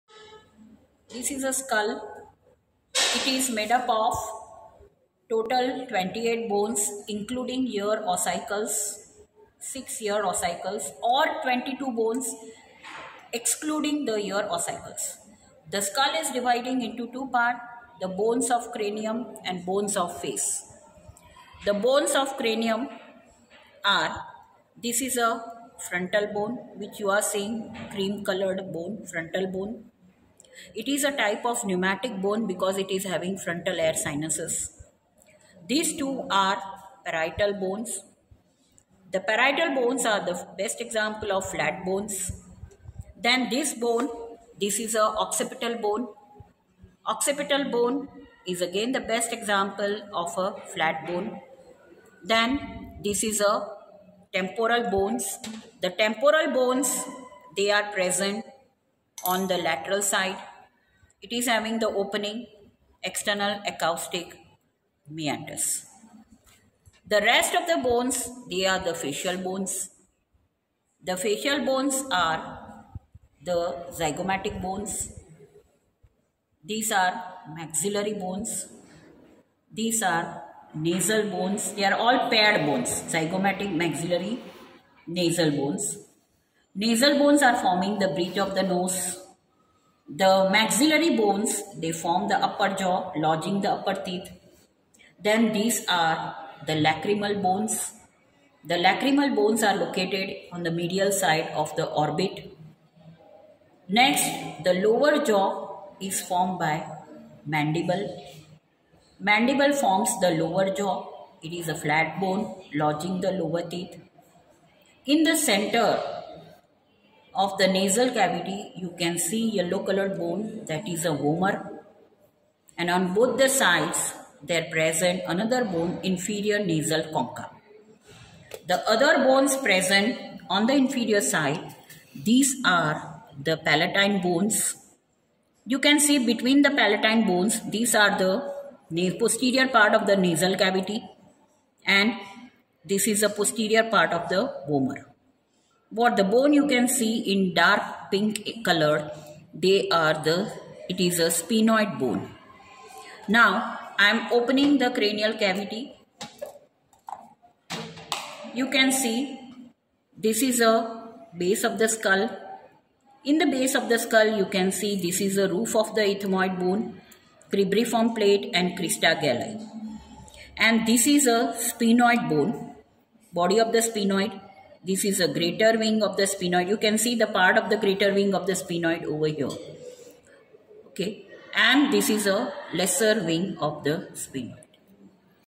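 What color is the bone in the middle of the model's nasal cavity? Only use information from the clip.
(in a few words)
Yellow.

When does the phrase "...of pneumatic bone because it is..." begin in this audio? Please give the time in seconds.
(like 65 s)
31 s.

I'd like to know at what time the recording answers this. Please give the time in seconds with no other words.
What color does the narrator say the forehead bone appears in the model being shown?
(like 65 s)
27 s.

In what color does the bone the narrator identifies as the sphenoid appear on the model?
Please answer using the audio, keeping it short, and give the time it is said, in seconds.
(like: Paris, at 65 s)
Dark pink, at 147 s.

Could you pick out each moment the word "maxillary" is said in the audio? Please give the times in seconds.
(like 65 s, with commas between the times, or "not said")
77 s, 83 s, 90 s.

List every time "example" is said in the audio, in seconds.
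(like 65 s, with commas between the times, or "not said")
40 s, 49 s.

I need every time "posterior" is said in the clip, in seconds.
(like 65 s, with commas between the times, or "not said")
139 s, 143 s.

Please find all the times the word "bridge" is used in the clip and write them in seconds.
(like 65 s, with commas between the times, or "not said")
88 s.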